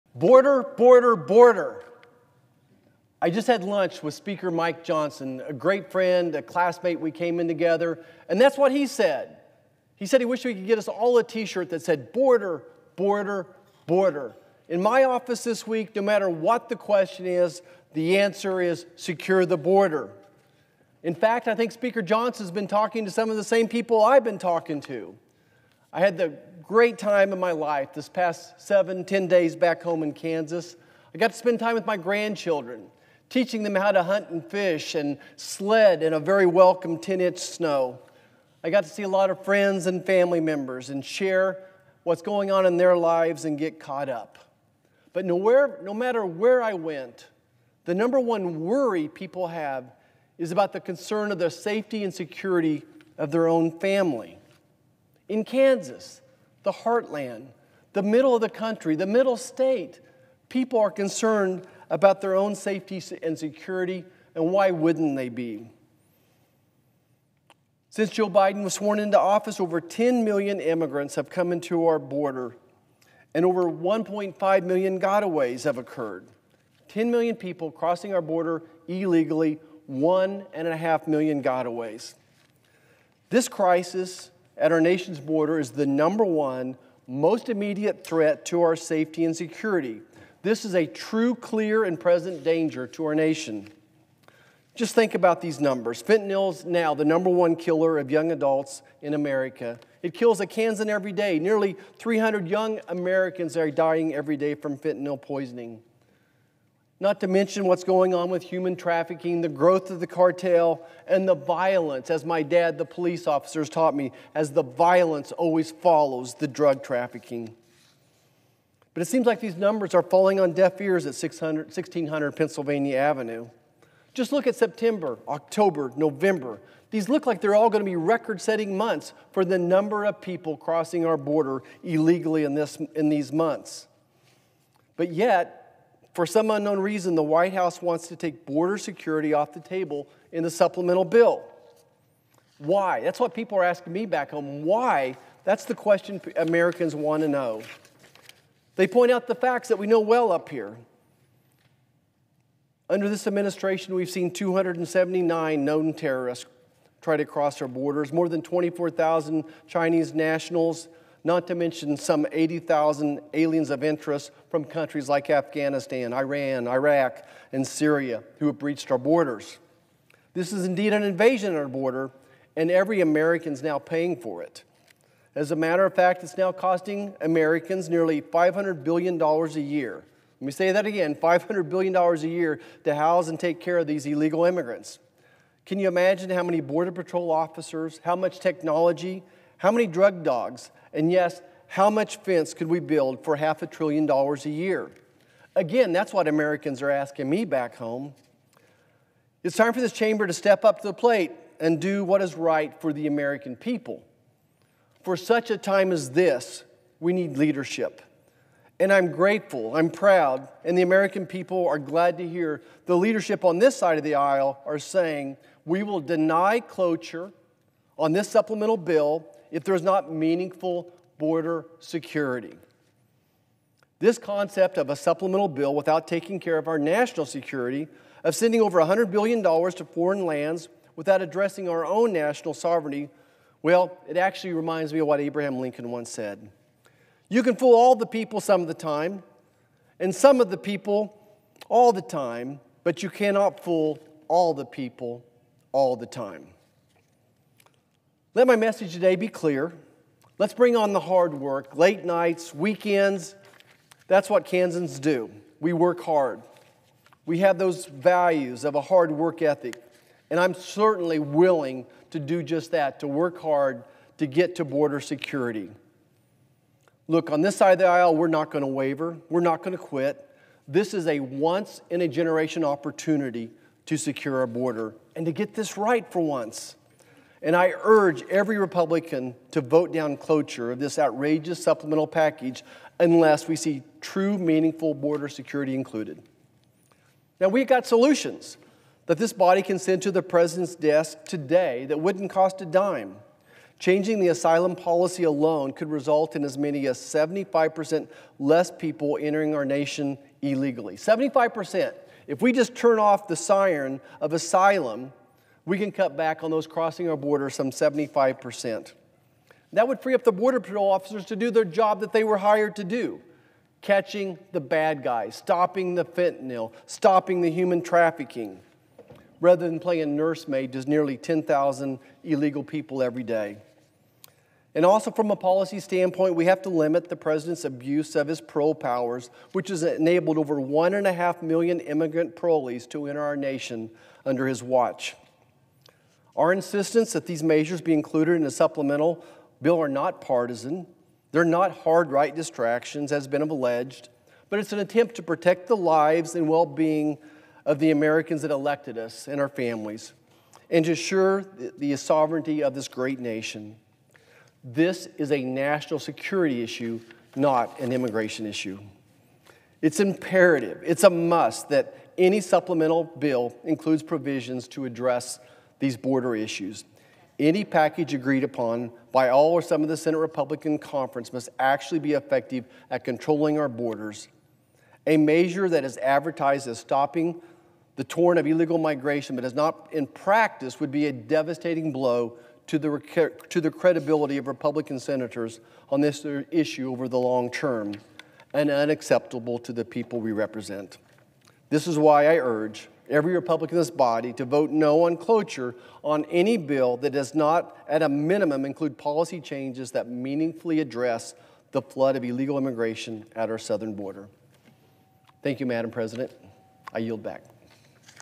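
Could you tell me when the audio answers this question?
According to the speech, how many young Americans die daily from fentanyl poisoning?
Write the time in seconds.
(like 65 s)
101 s.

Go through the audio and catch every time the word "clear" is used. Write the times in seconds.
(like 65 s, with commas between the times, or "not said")
91 s, 249 s.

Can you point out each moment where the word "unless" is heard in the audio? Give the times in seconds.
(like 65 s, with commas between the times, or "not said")
282 s.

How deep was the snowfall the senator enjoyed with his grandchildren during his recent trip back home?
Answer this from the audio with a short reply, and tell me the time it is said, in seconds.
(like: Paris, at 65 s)
10 inch, at 36 s.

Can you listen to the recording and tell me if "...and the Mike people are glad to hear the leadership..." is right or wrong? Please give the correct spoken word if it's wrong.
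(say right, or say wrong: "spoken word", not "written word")
wrong: "American", not "Mike".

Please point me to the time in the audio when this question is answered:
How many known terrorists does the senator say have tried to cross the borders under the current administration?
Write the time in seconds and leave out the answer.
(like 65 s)
154 s.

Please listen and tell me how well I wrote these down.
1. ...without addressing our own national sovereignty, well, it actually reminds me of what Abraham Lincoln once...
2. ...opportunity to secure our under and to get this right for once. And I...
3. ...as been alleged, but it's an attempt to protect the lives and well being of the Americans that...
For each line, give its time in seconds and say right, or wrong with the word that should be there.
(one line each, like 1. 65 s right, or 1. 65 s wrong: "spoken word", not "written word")
1. 230 s right
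2. 272 s wrong: "border", not "under"
3. 343 s right.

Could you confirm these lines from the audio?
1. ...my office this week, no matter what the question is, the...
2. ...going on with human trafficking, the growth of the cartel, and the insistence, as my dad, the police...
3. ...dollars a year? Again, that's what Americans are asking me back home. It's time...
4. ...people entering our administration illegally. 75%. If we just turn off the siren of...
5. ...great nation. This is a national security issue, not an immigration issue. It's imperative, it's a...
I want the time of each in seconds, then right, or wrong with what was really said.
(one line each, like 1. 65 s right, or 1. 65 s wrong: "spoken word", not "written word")
1. 14 s right
2. 107 s wrong: "violence", not "insistence"
3. 194 s right
4. 298 s wrong: "nation", not "administration"
5. 352 s right.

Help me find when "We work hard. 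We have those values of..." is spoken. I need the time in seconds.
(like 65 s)
255 s.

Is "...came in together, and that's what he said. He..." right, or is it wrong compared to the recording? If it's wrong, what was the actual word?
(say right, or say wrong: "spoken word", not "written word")
right.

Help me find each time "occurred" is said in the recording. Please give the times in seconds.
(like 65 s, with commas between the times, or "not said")
75 s.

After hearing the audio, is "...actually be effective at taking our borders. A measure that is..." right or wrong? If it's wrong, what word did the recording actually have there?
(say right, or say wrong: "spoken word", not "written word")
wrong: "controlling", not "taking".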